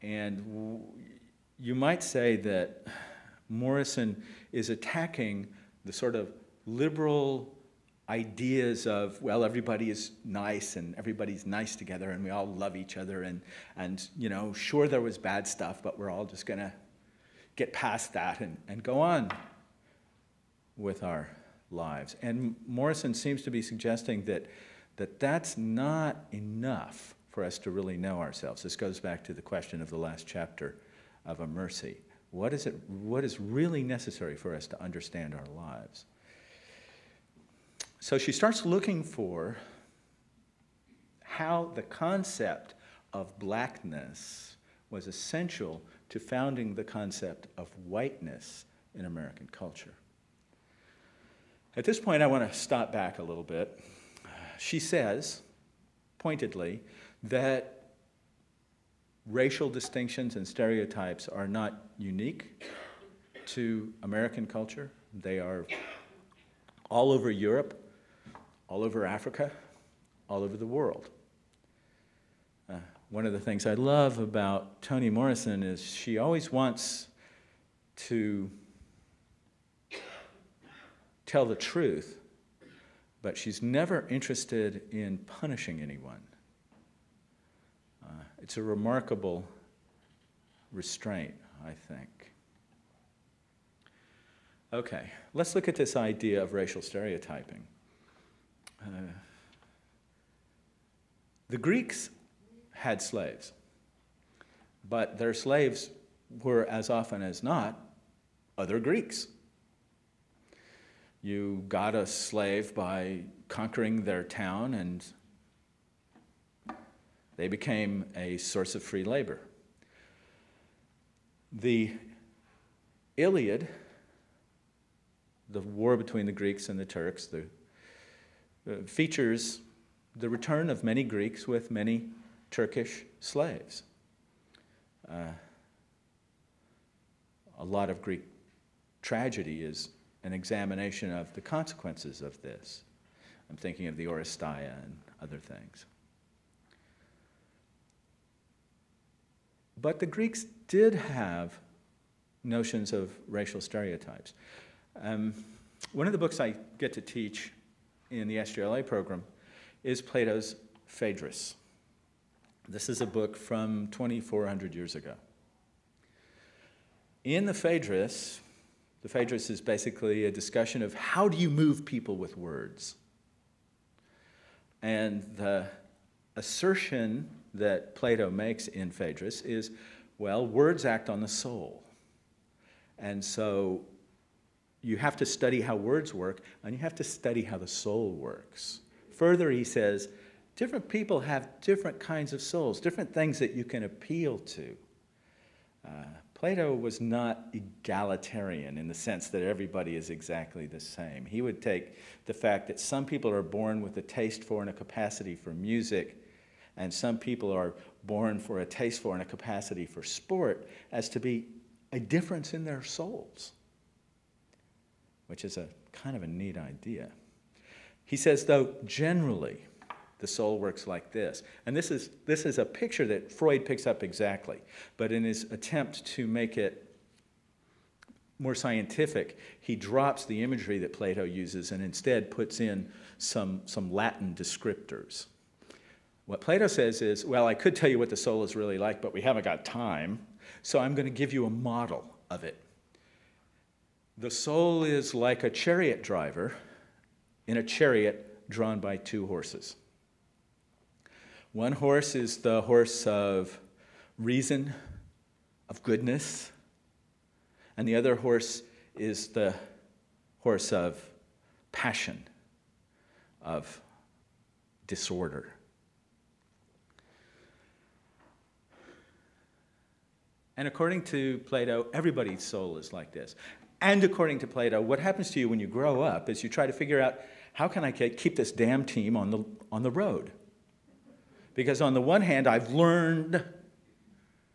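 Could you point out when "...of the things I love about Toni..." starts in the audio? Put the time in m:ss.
1:13.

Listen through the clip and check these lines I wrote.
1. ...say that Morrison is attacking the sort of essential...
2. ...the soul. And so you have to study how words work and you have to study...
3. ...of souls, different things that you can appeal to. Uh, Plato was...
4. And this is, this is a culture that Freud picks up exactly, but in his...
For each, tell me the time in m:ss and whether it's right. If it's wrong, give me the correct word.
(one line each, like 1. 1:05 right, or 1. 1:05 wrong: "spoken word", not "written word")
1. 0:02 wrong: "liberal", not "essential"
2. 3:01 right
3. 3:12 right
4. 3:41 wrong: "picture", not "culture".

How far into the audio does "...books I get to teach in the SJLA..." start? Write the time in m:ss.
2:36.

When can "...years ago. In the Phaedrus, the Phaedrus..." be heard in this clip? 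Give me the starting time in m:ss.
2:44.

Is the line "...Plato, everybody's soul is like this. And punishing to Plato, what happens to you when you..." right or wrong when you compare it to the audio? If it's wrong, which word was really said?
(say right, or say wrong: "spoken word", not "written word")
wrong: "according", not "punishing".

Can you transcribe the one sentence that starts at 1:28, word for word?
Uh, it's a remarkable restraint, I think.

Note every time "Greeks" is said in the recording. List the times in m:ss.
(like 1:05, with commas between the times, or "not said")
1:41, 1:48, 2:06, 2:11, 2:18, 2:30.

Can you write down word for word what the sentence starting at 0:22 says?
And Morrison seems to be suggesting that, that that's not enough for us to really know ourselves.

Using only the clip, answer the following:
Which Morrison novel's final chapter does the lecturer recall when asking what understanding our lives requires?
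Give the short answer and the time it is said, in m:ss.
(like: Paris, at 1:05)
A Mercy, at 0:31.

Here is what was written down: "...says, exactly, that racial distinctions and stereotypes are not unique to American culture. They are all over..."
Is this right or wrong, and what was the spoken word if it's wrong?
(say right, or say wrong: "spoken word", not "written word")
wrong: "pointedly", not "exactly".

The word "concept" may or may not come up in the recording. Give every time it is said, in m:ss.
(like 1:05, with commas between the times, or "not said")
0:41, 0:46.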